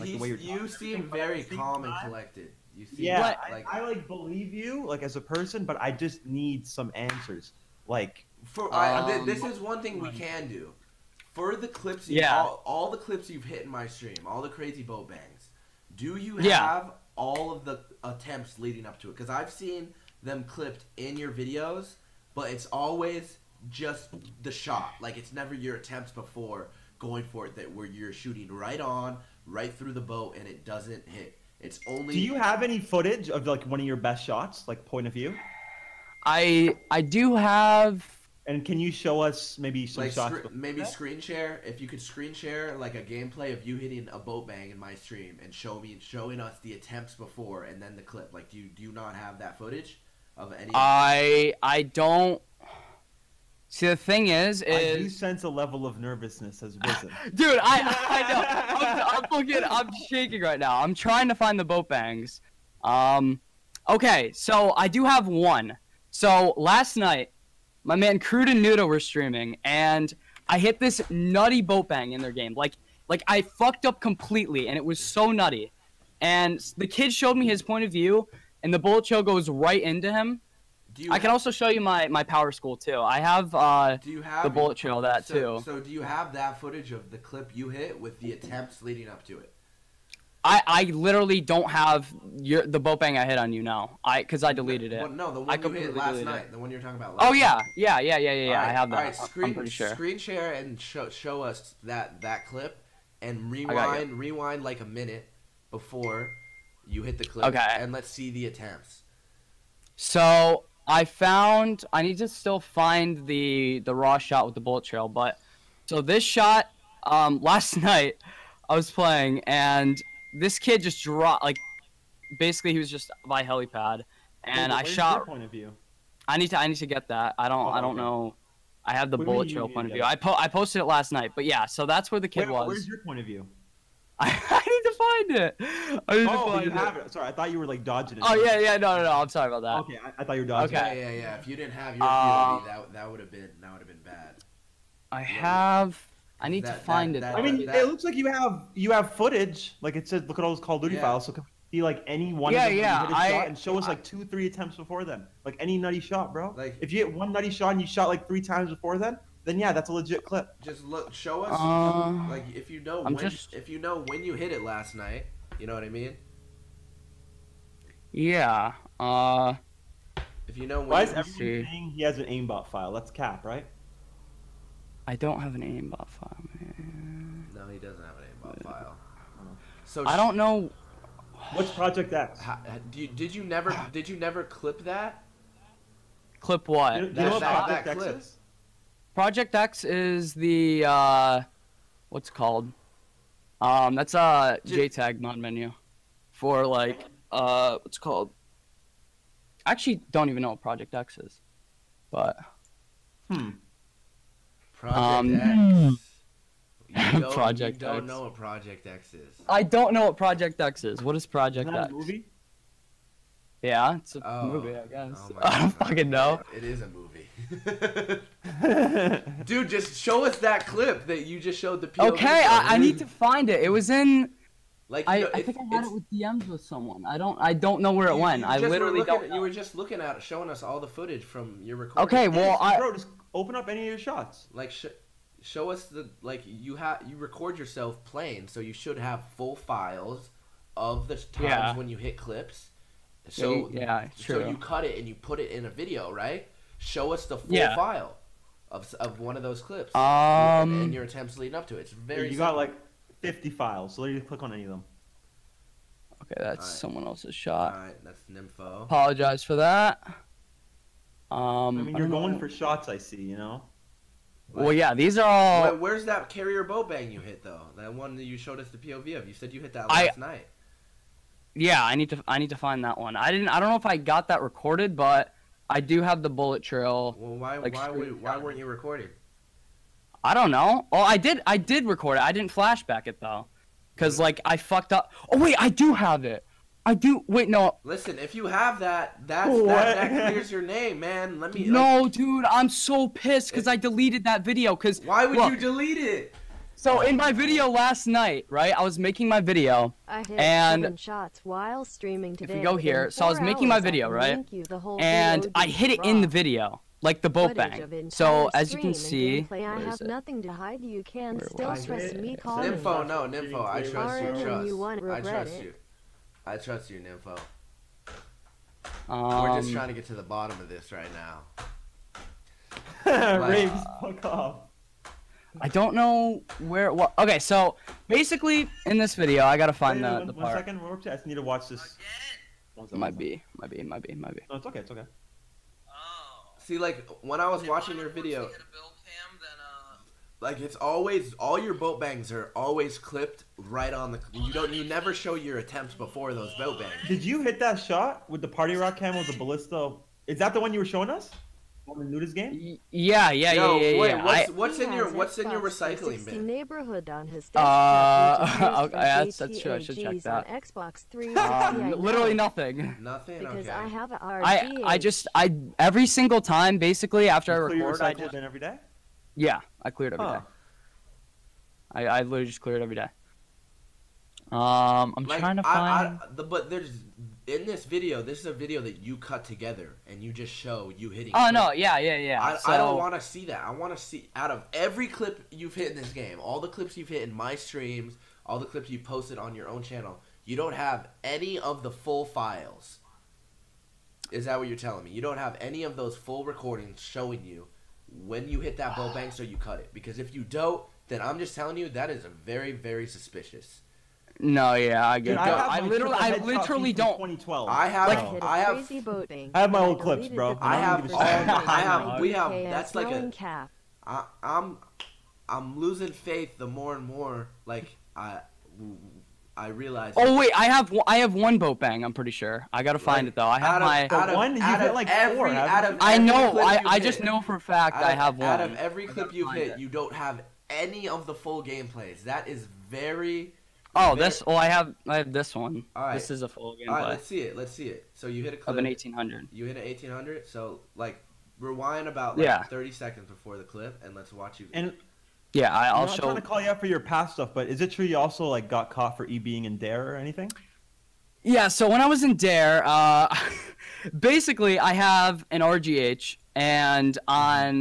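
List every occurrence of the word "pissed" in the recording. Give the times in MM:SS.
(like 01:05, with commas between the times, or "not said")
04:53.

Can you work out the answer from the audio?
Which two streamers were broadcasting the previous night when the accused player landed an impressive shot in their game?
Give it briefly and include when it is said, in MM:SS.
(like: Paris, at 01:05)
Crude and Nudo, at 01:08.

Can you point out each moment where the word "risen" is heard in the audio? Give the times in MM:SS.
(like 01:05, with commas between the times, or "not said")
00:56.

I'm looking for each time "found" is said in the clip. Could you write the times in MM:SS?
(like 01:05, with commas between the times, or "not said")
01:51.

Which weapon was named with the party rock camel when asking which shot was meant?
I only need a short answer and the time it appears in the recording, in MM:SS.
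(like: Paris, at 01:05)
ballista, at 05:49.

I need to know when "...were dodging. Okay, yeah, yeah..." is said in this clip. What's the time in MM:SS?
02:20.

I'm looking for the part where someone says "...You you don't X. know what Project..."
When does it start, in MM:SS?
03:27.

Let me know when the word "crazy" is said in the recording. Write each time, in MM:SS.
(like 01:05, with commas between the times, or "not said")
00:14, 06:48.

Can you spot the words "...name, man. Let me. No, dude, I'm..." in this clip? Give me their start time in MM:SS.
04:50.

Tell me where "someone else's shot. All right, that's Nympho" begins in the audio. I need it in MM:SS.
04:16.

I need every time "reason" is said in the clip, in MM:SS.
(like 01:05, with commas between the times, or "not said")
not said.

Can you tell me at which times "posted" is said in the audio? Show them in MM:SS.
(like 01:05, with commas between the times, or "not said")
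02:10, 06:28.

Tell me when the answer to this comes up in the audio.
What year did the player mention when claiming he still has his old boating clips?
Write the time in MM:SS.
06:47.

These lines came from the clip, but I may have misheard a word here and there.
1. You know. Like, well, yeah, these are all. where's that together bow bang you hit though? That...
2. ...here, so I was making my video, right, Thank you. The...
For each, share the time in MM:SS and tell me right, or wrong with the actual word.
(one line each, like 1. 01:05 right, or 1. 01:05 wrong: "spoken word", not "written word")
1. 04:23 wrong: "carrier", not "together"
2. 05:02 right.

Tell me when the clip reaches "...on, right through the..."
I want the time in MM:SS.
00:28.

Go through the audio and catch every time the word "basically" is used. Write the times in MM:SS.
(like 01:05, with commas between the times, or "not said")
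02:02, 05:28, 06:06, 07:34.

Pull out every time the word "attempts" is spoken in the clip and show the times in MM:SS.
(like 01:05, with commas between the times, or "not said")
00:18, 00:25, 00:46, 01:28, 01:48, 02:34, 04:11, 05:45.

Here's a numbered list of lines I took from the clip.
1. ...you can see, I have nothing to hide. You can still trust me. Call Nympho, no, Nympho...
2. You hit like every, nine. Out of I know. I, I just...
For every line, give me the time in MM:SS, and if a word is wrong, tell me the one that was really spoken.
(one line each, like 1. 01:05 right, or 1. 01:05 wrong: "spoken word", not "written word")
1. 05:08 right
2. 07:04 wrong: "four", not "nine".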